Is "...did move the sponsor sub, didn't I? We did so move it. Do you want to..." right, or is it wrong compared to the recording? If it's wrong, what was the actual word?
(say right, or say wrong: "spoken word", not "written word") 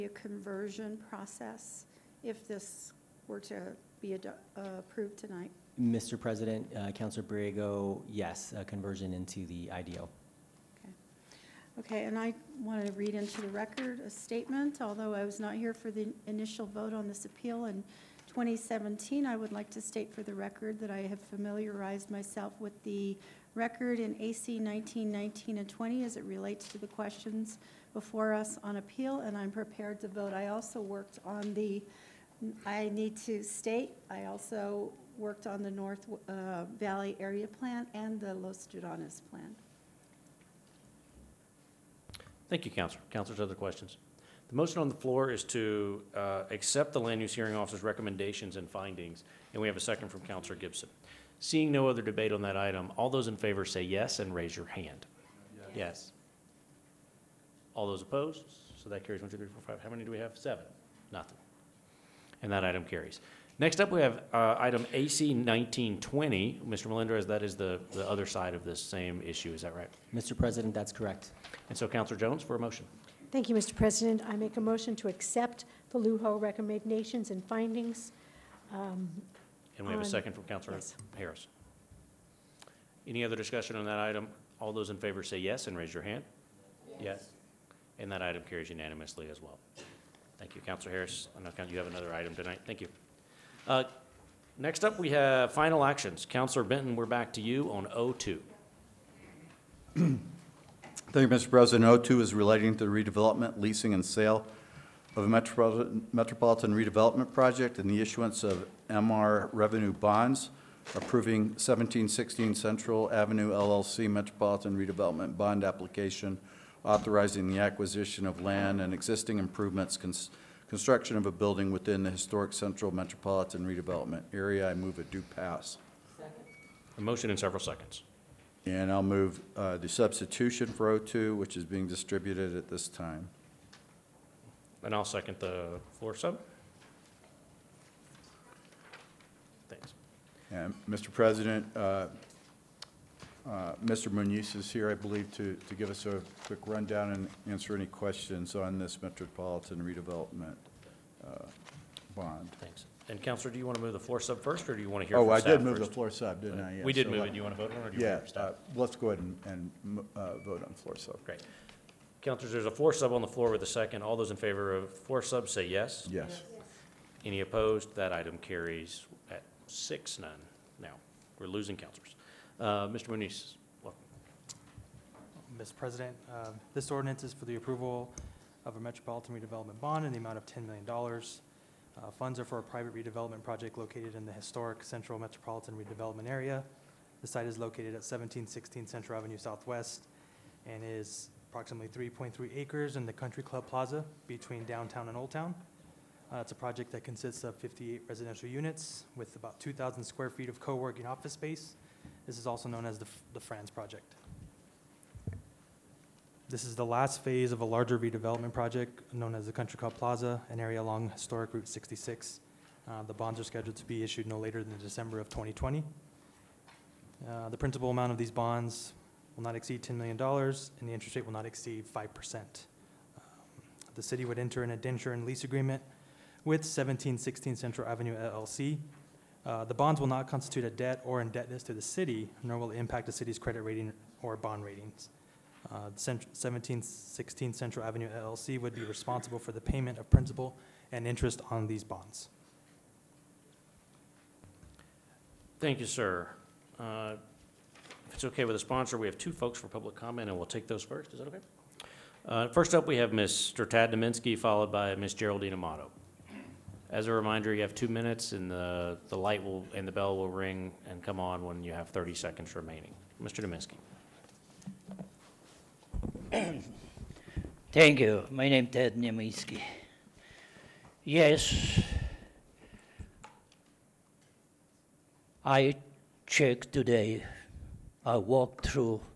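wrong: "floor", not "sponsor".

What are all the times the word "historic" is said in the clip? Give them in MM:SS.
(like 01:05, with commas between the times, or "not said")
02:02, 03:04, 03:31.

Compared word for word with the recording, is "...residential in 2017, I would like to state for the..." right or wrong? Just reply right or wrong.
wrong.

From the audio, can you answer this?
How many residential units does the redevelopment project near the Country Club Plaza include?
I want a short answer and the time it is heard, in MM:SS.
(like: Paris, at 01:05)
58, at 03:17.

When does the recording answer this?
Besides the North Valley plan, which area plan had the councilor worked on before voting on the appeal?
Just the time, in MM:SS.
00:38.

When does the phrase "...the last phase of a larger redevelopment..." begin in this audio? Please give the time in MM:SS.
03:26.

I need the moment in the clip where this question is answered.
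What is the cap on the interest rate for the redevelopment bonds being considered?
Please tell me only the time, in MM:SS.
03:41.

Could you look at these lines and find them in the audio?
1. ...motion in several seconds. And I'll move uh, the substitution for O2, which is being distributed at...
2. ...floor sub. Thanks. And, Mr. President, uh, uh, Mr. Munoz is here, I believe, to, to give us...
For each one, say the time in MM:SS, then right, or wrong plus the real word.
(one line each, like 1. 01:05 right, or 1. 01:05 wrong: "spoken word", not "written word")
1. 02:06 right
2. 02:15 right.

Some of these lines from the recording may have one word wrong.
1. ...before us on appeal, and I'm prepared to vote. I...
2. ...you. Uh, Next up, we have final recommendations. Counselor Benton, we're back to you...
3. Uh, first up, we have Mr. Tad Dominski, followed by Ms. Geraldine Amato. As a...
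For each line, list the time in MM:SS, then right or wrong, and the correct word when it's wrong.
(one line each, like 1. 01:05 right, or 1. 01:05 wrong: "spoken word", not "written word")
1. 00:27 right
2. 01:32 wrong: "actions", not "recommendations"
3. 04:12 right.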